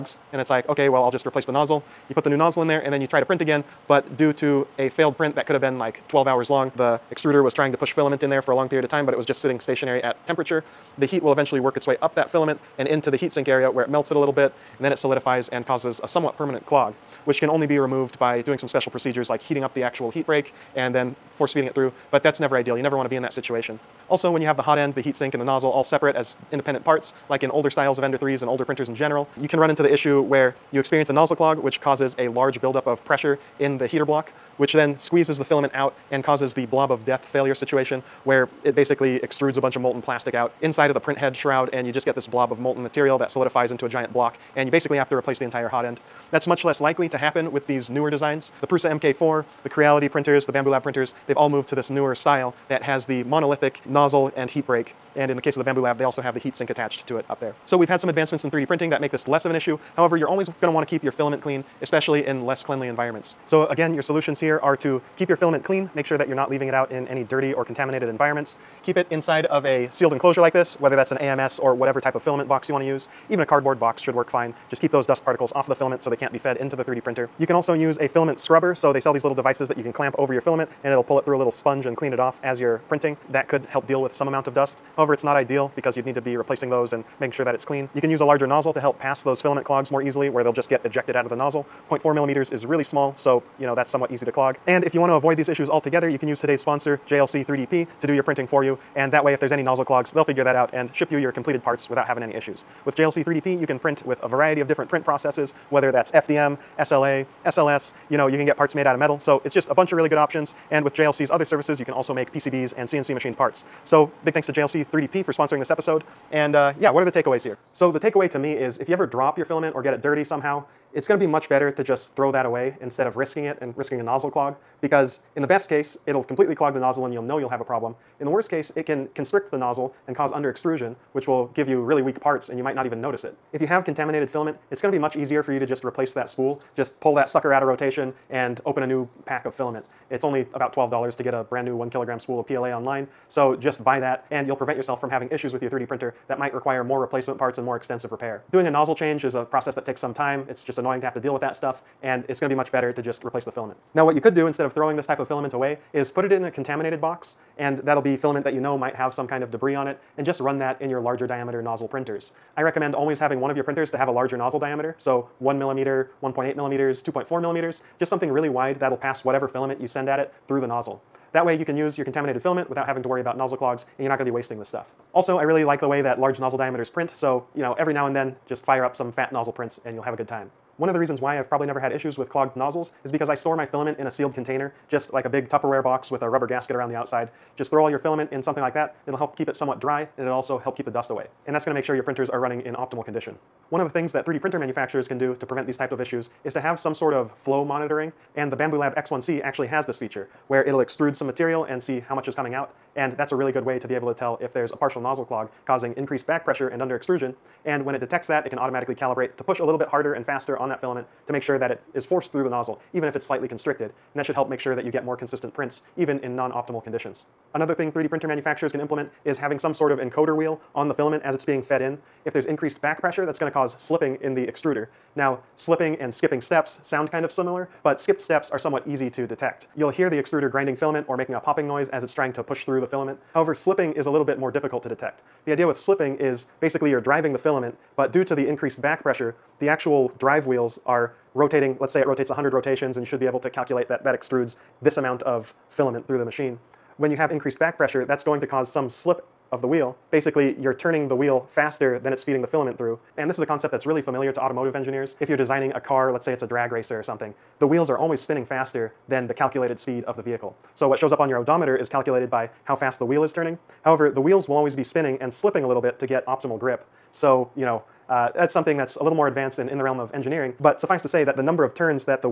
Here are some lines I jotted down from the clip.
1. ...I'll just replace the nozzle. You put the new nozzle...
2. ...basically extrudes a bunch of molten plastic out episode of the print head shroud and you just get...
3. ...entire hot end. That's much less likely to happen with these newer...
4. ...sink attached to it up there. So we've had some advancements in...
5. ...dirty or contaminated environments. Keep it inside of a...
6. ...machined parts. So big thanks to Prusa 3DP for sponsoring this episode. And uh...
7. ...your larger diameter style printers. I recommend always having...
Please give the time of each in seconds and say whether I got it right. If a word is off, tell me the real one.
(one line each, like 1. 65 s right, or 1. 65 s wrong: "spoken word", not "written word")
1. 1 s right
2. 38 s wrong: "inside", not "episode"
3. 45 s right
4. 56 s right
5. 67 s right
6. 113 s wrong: "JLC", not "Prusa"
7. 160 s wrong: "nozzle", not "style".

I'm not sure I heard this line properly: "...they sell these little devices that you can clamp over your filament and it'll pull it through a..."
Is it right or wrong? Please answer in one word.
right.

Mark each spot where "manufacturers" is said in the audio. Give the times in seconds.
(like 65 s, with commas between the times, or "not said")
194 s, 218 s.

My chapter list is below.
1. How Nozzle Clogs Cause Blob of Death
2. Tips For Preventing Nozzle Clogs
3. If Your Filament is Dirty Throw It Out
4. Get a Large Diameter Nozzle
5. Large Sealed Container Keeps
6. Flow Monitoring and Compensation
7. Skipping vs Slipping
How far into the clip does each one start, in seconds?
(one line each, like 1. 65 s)
1. 28 s
2. 62 s
3. 116 s
4. 153 s
5. 179 s
6. 193 s
7. 224 s.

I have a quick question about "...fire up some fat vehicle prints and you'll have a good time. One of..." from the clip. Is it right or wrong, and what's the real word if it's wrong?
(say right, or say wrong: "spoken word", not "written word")
wrong: "nozzle", not "vehicle".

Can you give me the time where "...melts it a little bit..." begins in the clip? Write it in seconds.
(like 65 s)
13 s.